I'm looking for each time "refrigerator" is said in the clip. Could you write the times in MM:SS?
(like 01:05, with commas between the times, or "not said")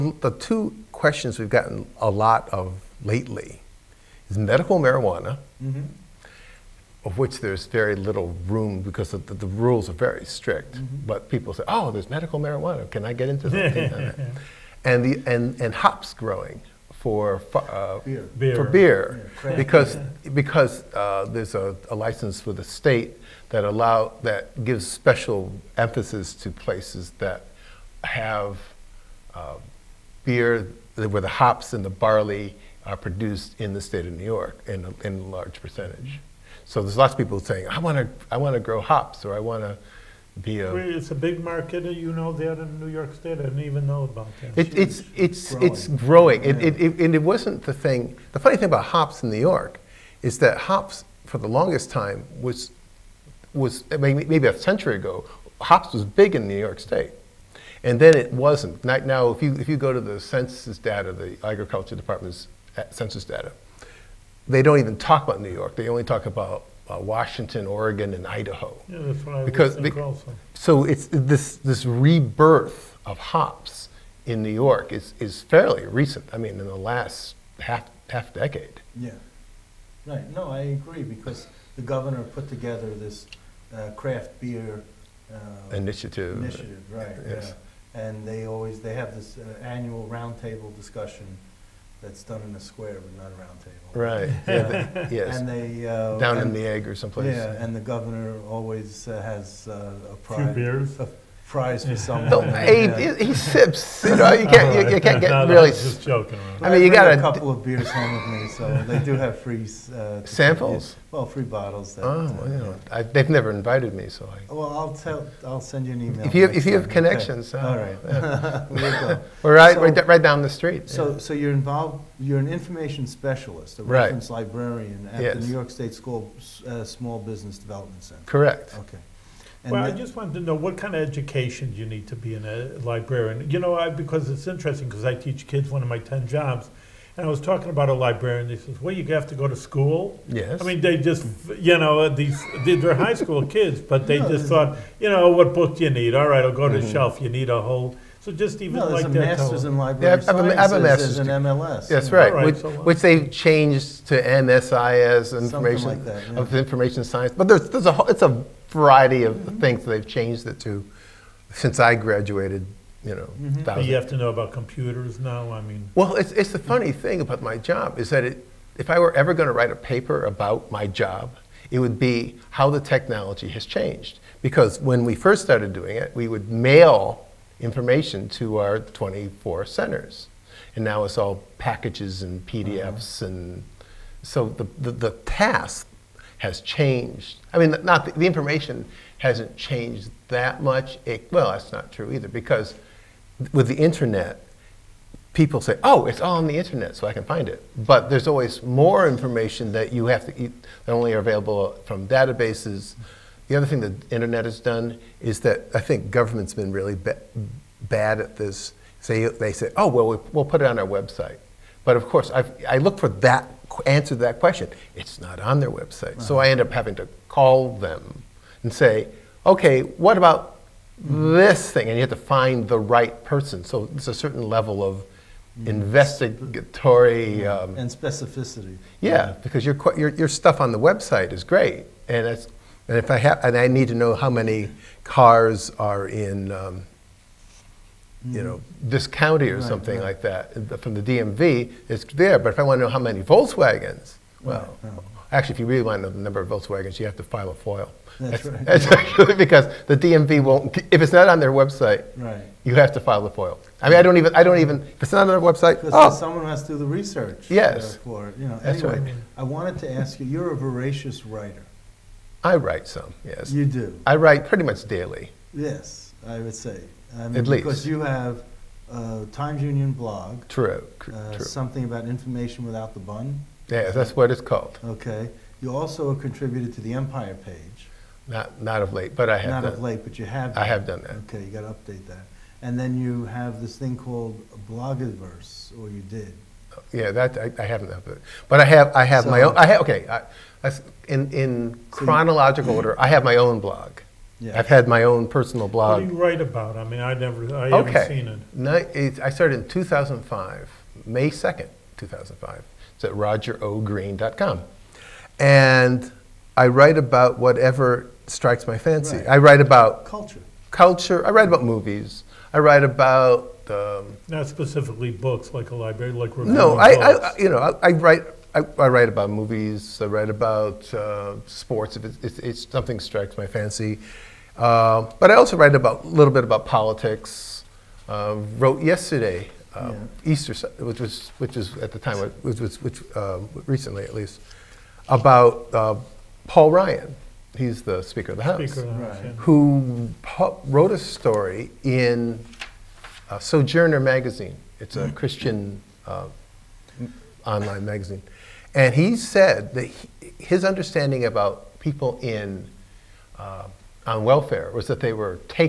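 not said.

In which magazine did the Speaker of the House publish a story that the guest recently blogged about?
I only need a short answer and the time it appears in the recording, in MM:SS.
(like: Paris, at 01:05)
Sojourner, at 05:43.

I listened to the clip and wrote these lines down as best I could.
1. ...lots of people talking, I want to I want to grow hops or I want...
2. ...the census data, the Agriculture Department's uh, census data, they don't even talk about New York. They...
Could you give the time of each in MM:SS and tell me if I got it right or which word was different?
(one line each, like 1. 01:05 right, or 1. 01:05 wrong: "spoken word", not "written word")
1. 00:36 wrong: "saying", not "talking"
2. 01:00 right.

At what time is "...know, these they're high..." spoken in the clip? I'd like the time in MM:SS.
02:21.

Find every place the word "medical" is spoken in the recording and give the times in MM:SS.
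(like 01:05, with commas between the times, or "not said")
00:04, 00:12.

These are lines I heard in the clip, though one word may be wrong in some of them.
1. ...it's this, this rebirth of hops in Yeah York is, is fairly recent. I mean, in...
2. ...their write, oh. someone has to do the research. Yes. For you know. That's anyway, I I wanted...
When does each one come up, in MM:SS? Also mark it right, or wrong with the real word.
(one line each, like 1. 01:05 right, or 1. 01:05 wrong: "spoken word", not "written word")
1. 01:10 wrong: "New", not "Yeah"
2. 04:15 wrong: "website", not "write".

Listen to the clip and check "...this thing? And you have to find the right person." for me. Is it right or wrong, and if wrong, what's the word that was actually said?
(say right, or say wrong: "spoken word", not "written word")
right.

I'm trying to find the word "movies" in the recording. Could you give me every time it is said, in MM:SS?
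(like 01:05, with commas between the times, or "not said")
05:11, 05:19.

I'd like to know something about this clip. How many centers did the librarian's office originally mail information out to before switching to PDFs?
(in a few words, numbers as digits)
24.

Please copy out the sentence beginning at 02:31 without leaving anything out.
That's right, right which, so which, they've changed to MSIS, information like that, yeah.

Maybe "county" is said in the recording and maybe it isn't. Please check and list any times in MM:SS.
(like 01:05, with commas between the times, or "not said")
03:59.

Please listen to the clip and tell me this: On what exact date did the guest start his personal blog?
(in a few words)
May 2, 2005.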